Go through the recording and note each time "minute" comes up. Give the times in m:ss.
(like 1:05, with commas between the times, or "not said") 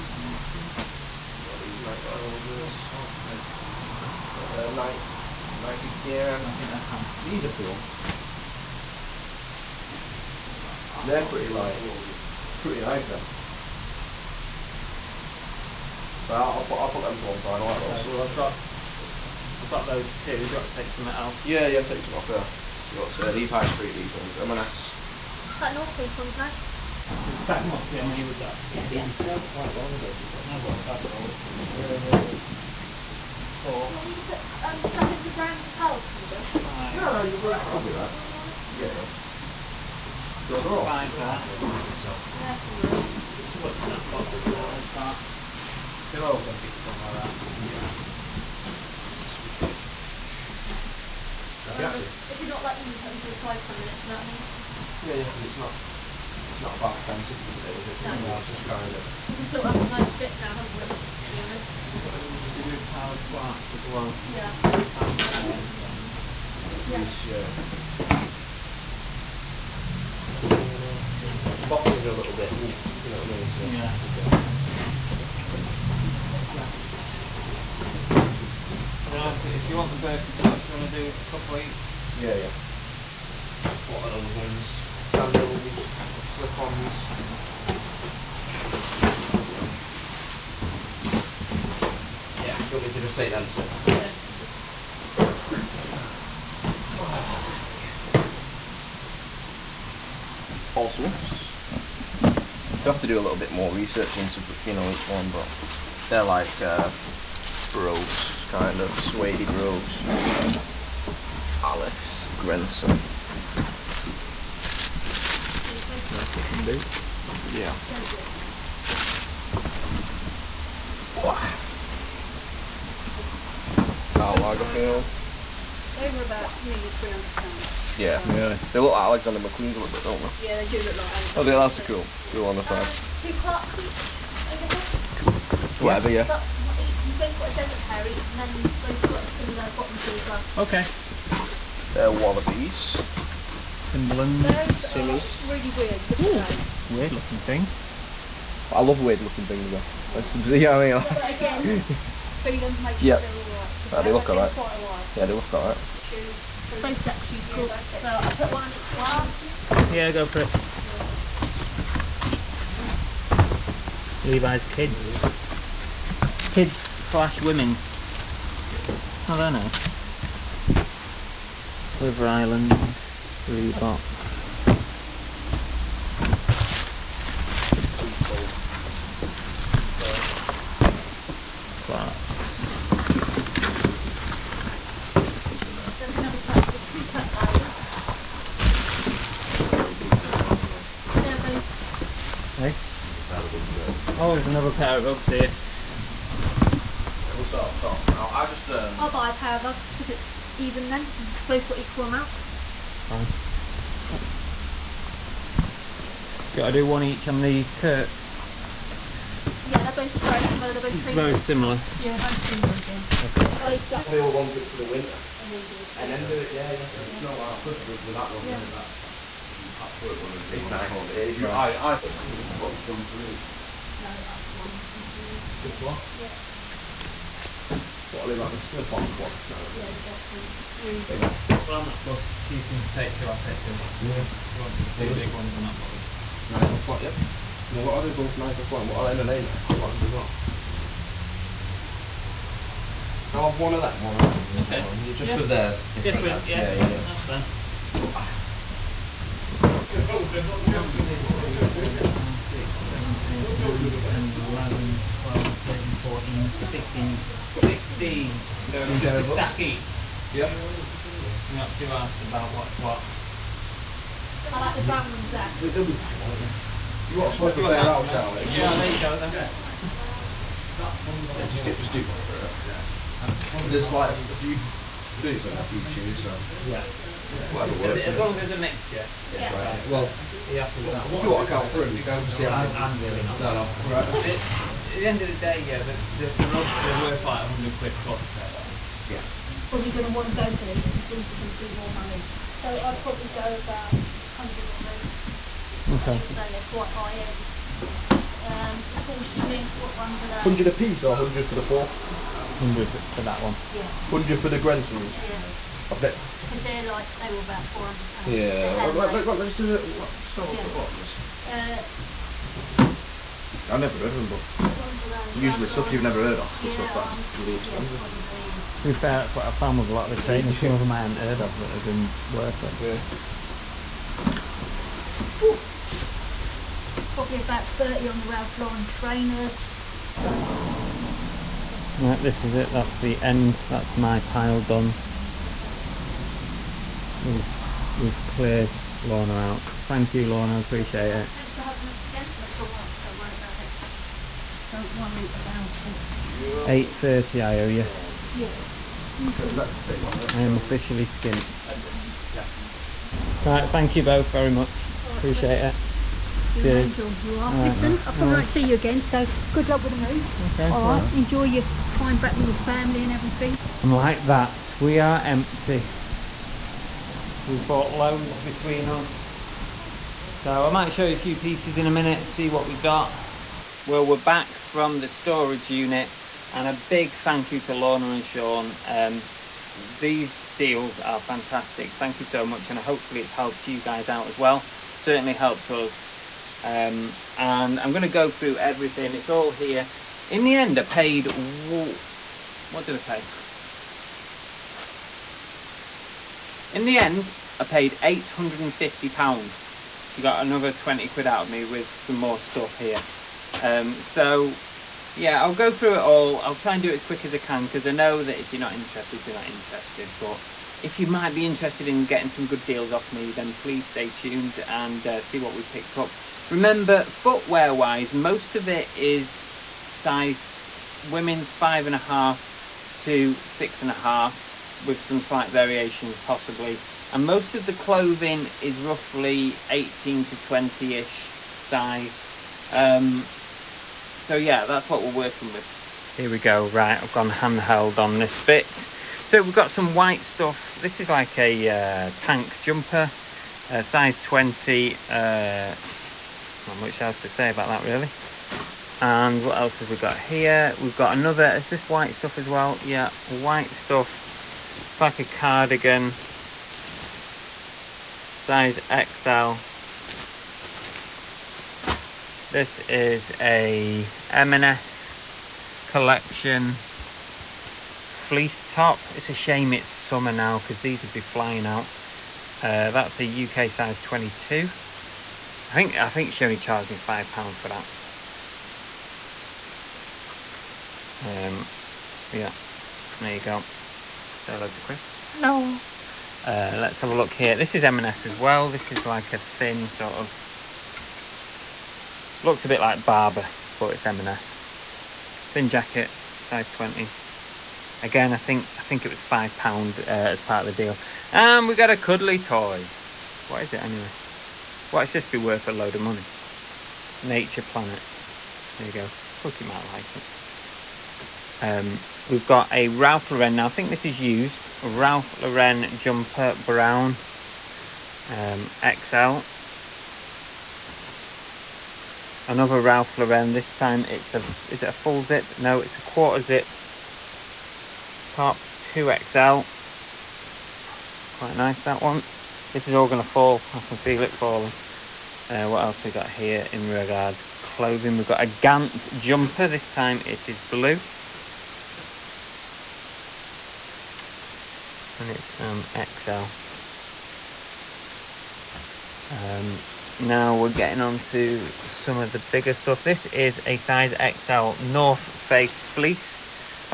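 0:53, 6:11.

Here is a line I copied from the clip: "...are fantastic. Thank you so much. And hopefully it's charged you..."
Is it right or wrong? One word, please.
wrong.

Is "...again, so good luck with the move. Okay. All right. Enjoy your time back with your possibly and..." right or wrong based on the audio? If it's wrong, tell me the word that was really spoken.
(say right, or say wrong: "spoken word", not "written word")
wrong: "family", not "possibly".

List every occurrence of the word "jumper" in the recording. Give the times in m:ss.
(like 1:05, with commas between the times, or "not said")
7:22, 8:35, 8:59.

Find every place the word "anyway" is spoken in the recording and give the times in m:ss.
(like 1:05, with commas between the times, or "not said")
8:23.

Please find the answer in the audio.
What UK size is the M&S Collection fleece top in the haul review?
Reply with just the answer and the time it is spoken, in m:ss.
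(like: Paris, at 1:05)
22, at 7:53.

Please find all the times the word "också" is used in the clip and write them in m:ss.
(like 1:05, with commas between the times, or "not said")
0:46.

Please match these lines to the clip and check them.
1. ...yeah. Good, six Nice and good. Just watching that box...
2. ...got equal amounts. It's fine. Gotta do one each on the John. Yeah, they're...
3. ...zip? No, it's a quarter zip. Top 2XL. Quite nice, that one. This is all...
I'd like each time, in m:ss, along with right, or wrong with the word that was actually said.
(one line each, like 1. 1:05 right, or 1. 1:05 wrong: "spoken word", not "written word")
1. 0:38 wrong: "five", not "six"
2. 3:21 wrong: "Kirks", not "John"
3. 8:45 right.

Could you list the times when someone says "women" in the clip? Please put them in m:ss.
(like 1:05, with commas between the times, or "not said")
2:47, 7:01.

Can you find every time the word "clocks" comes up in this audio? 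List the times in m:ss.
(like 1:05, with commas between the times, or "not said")
2:13, 3:49.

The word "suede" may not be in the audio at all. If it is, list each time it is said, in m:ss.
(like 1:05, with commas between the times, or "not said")
1:49.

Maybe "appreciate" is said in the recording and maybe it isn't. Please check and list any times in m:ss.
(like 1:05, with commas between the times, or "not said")
5:40, 5:55.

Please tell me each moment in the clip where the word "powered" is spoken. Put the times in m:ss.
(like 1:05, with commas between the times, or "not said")
1:02.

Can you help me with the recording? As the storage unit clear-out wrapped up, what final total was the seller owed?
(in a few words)
8.30.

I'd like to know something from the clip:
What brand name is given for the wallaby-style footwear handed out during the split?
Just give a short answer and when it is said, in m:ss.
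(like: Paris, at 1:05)
Timberland, at 2:23.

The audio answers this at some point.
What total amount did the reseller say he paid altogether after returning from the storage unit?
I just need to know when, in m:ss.
6:38.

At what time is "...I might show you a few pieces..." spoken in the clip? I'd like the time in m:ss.
6:10.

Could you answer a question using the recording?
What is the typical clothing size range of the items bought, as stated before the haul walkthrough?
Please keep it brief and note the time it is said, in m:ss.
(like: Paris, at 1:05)
18 to 20, at 7:09.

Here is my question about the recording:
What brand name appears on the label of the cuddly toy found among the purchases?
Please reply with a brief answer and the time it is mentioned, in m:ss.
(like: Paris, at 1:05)
Nature Planet, at 8:27.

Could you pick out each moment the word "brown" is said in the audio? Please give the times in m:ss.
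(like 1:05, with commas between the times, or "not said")
4:24, 8:36.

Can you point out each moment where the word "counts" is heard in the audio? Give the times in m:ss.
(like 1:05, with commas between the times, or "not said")
0:06, 4:41.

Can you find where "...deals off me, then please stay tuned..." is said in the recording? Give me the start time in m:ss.
6:52.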